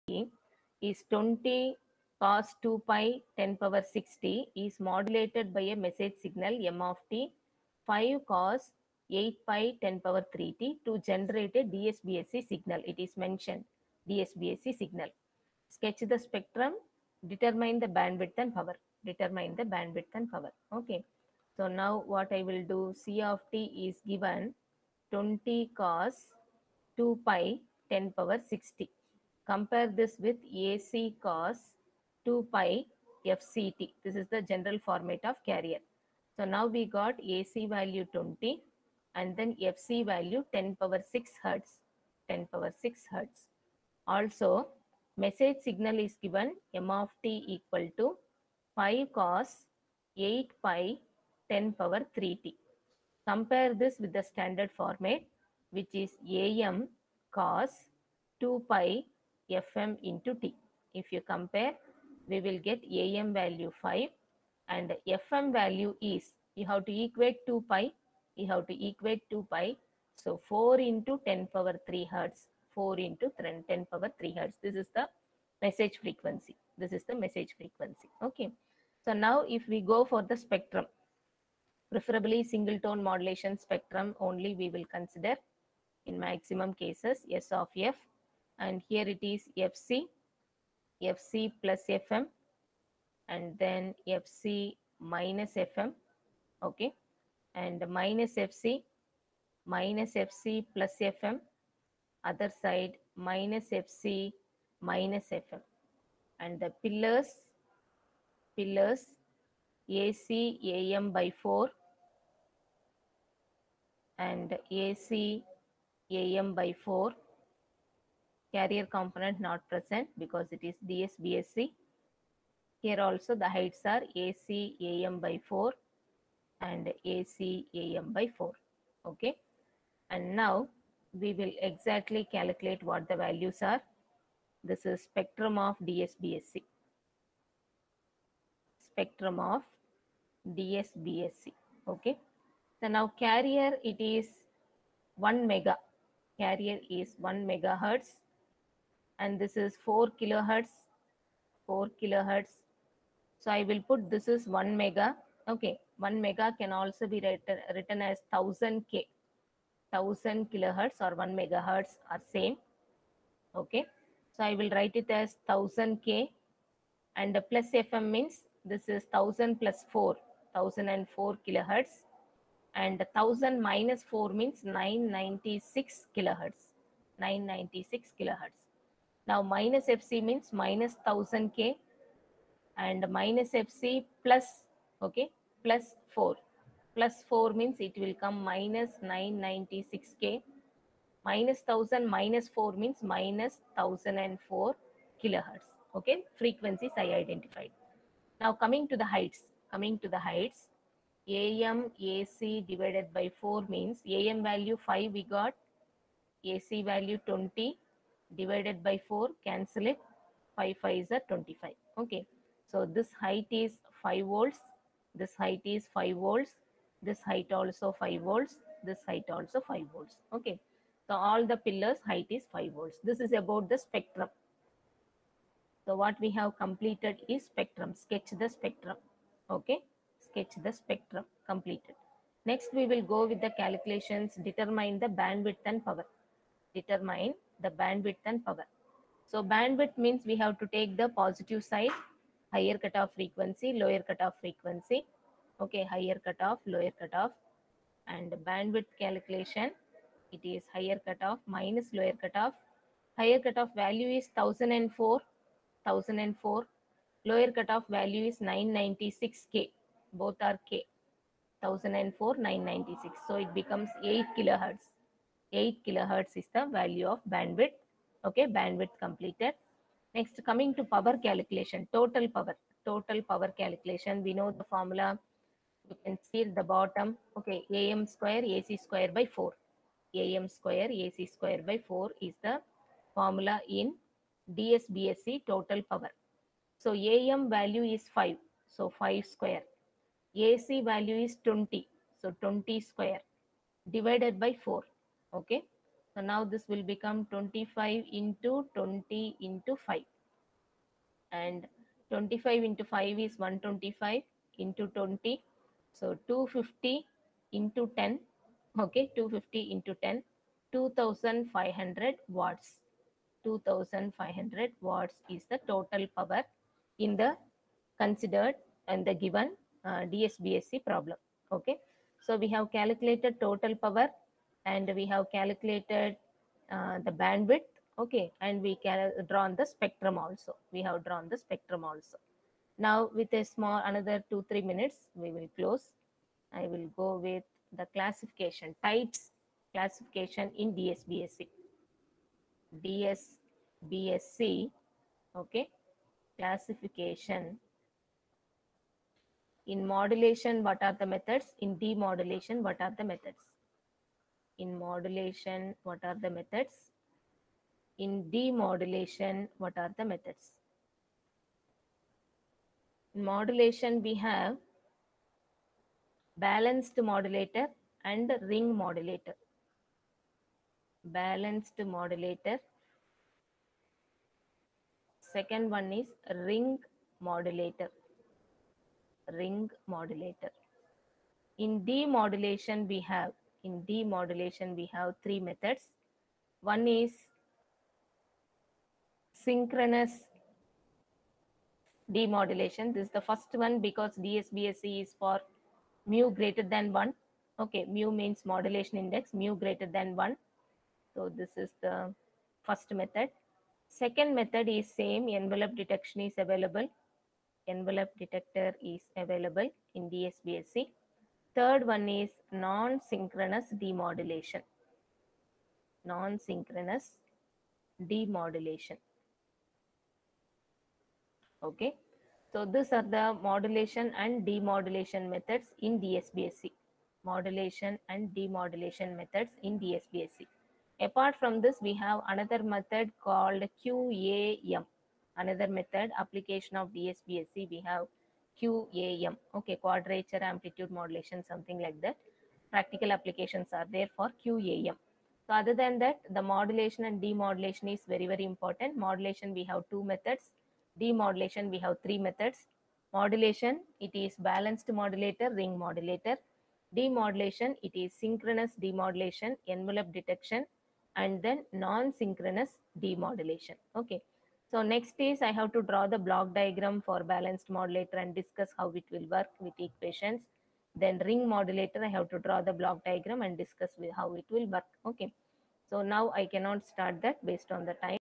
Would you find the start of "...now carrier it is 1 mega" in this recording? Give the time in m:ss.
2:22.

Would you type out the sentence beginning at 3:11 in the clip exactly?
Minus 1000 minus 4 means minus 1004 kilohertz.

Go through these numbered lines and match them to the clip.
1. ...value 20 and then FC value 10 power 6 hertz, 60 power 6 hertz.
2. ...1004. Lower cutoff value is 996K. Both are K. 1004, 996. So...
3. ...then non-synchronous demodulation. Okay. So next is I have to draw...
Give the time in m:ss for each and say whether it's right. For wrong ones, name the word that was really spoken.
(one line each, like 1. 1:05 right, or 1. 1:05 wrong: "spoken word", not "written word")
1. 0:37 wrong: "10", not "60"
2. 4:15 right
3. 7:41 right.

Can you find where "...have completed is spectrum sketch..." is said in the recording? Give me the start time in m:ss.
3:46.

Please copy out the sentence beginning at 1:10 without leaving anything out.
So 4 into 10 power 3 hertz, 4 into 10 power 3 hertz.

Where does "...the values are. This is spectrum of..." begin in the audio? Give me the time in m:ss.
2:13.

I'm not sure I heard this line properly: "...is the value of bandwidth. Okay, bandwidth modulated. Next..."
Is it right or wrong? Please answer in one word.
wrong.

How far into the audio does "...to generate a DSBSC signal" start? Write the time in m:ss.
0:10.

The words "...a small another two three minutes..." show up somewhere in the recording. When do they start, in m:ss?
5:33.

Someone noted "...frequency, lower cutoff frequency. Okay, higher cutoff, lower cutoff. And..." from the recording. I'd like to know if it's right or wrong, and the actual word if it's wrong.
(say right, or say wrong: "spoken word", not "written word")
right.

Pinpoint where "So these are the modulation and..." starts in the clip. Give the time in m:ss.
7:02.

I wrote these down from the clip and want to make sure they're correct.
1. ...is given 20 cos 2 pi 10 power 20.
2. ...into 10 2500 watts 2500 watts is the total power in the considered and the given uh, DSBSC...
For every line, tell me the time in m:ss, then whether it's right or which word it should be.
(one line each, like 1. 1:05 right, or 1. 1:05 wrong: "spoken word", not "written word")
1. 0:23 wrong: "60", not "20"
2. 5:09 right.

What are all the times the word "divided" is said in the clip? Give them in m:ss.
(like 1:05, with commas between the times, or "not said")
3:22, 3:28, 4:53.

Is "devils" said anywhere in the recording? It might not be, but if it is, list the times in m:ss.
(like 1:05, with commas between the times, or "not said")
not said.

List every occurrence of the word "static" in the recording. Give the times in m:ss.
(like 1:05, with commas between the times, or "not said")
not said.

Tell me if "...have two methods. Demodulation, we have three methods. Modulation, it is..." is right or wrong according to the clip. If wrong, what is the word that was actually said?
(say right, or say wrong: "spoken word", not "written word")
right.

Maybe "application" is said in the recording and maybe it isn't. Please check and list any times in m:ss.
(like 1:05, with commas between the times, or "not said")
7:16, 7:23.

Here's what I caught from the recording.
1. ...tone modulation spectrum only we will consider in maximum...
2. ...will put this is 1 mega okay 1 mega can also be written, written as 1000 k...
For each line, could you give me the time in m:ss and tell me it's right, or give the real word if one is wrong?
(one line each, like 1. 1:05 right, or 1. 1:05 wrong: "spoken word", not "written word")
1. 1:22 right
2. 2:33 right.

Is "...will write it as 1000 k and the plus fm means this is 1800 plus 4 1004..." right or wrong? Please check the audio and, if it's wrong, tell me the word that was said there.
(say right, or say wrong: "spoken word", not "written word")
wrong: "1000", not "1800".